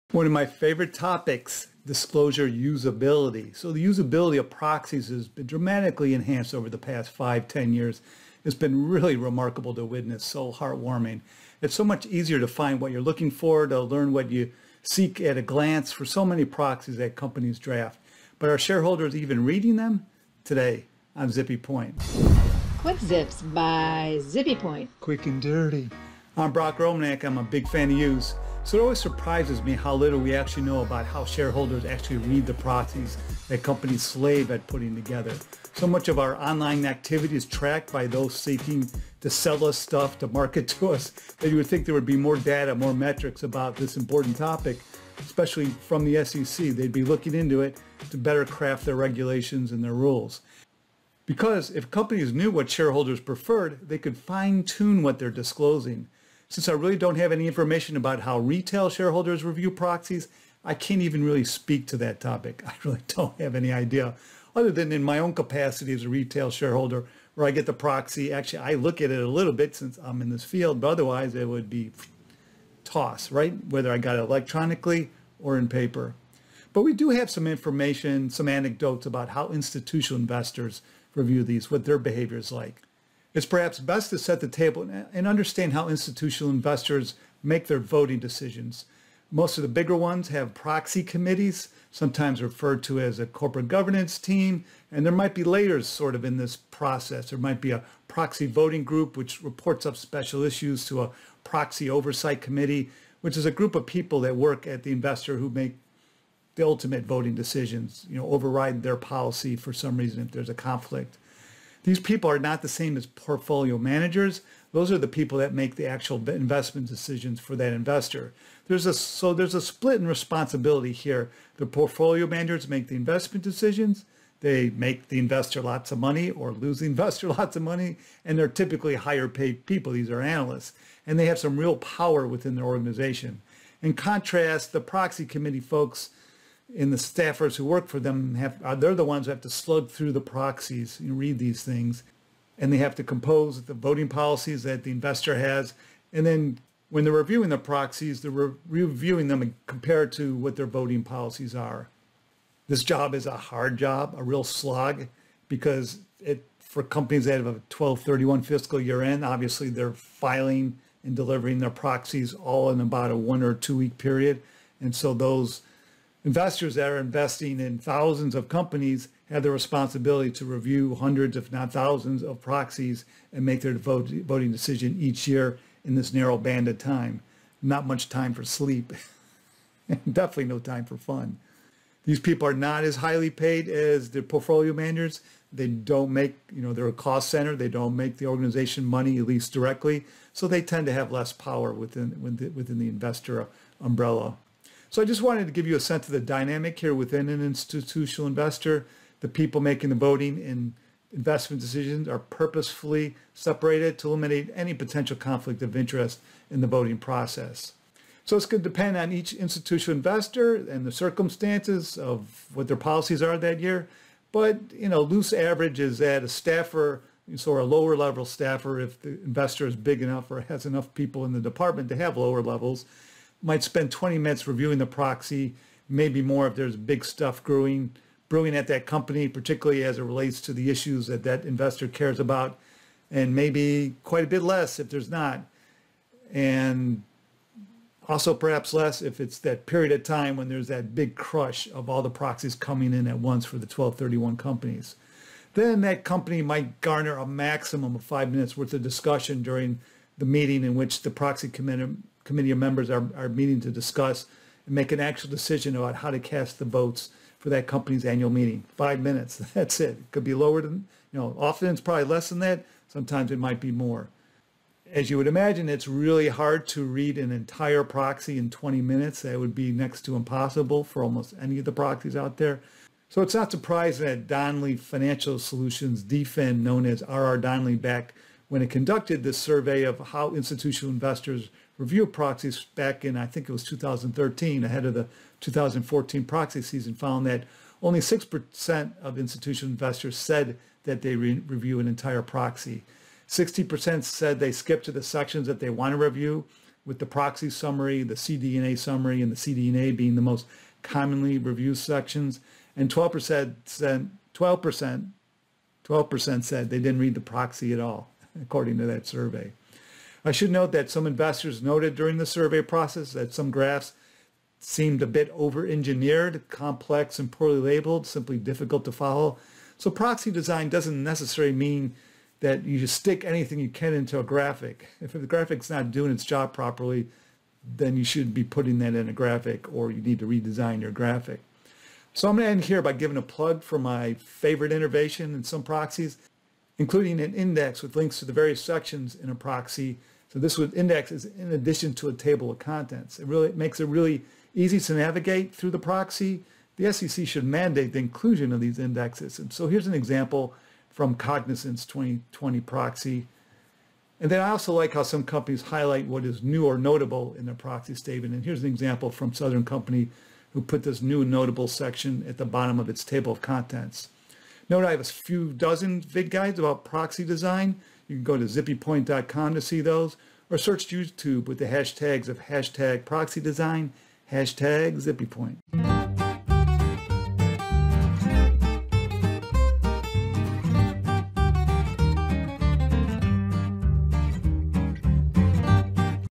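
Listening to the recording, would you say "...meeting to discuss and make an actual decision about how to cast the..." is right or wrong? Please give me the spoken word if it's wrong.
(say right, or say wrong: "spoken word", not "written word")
right.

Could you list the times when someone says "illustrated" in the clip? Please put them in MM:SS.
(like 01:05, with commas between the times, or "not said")
not said.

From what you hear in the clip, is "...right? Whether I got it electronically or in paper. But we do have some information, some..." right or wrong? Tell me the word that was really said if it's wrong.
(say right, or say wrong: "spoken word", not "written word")
right.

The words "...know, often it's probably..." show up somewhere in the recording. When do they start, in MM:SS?
04:21.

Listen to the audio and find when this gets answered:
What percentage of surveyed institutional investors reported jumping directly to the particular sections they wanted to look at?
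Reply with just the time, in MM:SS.
04:53.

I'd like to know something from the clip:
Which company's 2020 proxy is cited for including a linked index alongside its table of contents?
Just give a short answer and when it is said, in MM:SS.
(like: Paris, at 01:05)
Cognizant, at 05:51.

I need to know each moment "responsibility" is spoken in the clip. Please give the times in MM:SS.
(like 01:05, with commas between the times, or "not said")
02:00, 02:49.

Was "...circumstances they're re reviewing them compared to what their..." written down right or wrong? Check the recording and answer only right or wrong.
wrong.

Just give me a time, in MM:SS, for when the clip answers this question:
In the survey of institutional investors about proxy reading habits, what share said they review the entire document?
04:47.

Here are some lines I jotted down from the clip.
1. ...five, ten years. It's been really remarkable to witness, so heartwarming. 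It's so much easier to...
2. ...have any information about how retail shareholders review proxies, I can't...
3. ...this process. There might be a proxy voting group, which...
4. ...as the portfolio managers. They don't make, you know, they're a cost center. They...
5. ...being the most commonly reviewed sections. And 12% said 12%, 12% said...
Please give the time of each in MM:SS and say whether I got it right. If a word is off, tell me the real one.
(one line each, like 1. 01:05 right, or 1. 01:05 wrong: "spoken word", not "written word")
1. 00:07 right
2. 00:57 right
3. 01:36 right
4. 03:03 right
5. 04:59 right.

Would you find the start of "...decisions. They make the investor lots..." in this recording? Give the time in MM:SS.
02:03.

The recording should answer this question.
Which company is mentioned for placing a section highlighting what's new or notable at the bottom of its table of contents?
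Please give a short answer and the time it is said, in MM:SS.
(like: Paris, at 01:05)
Southern Company, at 05:59.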